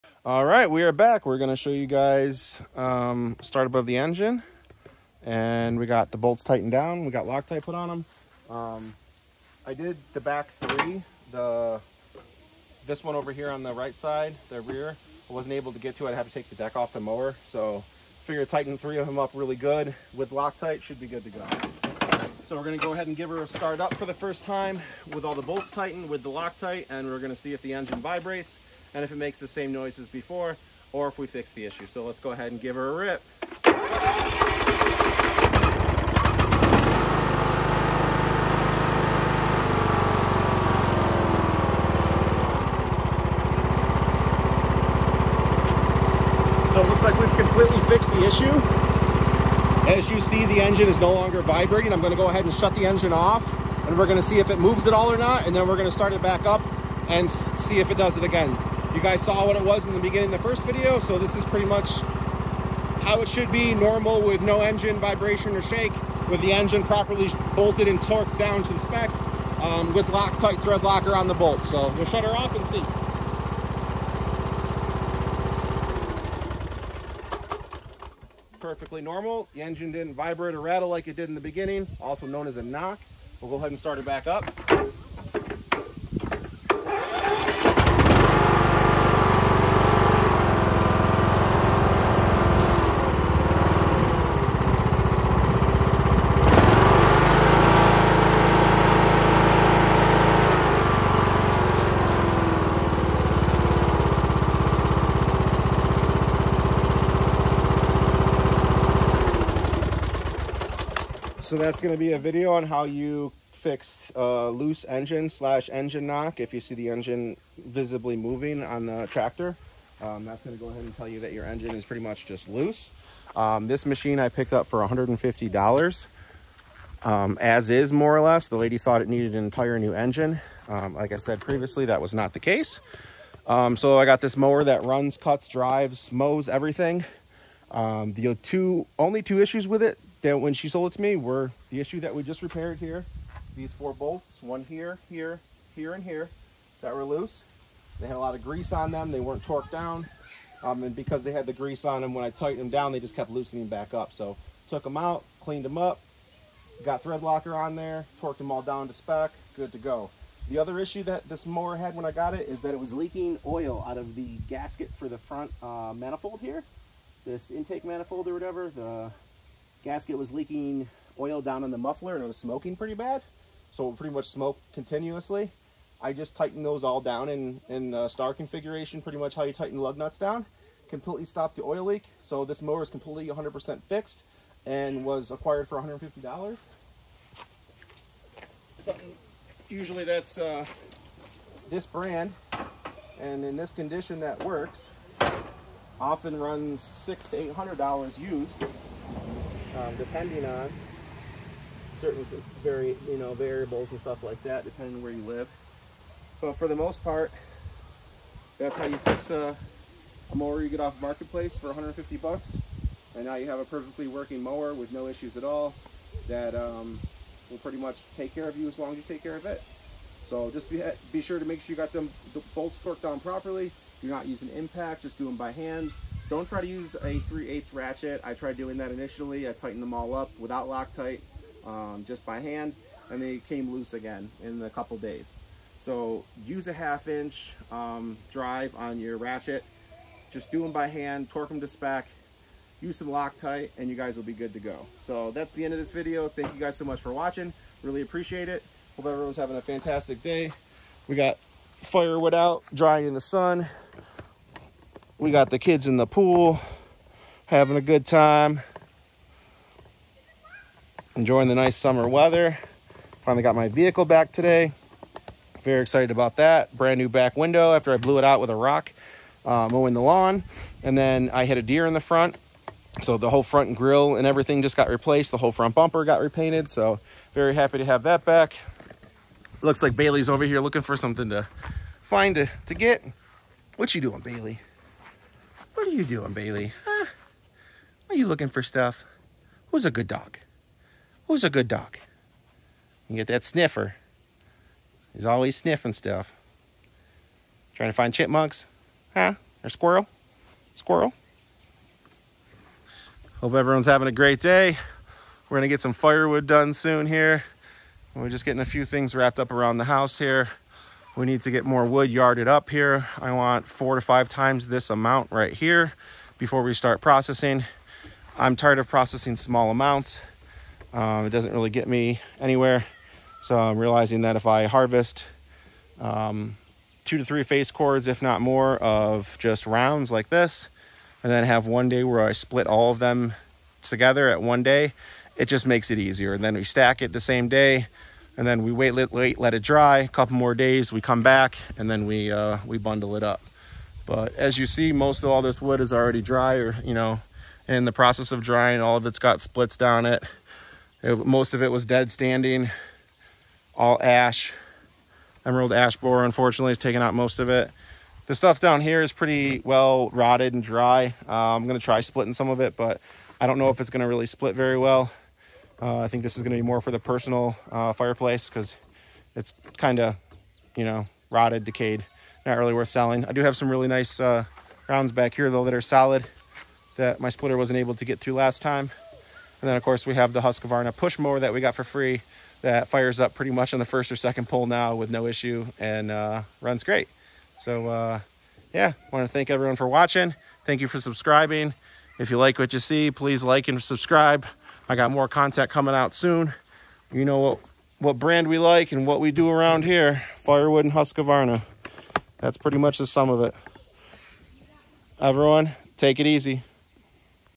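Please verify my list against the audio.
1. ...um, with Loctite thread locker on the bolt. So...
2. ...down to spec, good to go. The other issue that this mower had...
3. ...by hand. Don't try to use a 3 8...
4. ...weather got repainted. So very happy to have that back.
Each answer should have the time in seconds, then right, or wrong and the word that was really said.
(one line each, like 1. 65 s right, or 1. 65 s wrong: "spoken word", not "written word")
1. 69 s right
2. 158 s right
3. 225 s right
4. 275 s wrong: "bumper", not "weather".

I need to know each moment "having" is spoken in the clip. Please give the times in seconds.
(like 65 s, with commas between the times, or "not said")
249 s, 257 s, 303 s.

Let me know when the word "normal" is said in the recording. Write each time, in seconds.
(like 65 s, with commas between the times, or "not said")
63 s, 79 s.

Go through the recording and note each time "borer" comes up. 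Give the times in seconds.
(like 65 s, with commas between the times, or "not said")
355 s.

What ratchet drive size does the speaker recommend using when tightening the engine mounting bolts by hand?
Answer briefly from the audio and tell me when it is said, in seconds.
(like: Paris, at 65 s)
half inch, at 236 s.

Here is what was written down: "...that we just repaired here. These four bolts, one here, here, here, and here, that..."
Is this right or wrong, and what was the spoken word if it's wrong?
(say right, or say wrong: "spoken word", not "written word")
right.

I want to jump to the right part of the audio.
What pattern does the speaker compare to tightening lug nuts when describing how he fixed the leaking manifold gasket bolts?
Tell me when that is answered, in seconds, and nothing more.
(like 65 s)
178 s.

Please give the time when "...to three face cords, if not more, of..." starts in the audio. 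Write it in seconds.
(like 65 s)
327 s.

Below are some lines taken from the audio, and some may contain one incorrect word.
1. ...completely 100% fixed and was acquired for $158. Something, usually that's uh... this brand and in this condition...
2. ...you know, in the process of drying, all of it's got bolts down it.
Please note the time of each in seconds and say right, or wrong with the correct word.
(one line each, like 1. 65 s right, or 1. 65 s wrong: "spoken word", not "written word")
1. 182 s wrong: "150", not "158"
2. 346 s wrong: "splits", not "bolts".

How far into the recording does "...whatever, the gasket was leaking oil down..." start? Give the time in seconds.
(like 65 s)
168 s.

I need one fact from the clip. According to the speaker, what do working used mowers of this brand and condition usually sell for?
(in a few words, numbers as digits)
600 to 800 dollars.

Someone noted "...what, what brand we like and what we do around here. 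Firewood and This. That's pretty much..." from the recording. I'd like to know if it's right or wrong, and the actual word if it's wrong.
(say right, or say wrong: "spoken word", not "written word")
wrong: "Husqvarna", not "This".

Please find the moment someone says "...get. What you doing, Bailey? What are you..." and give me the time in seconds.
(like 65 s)
282 s.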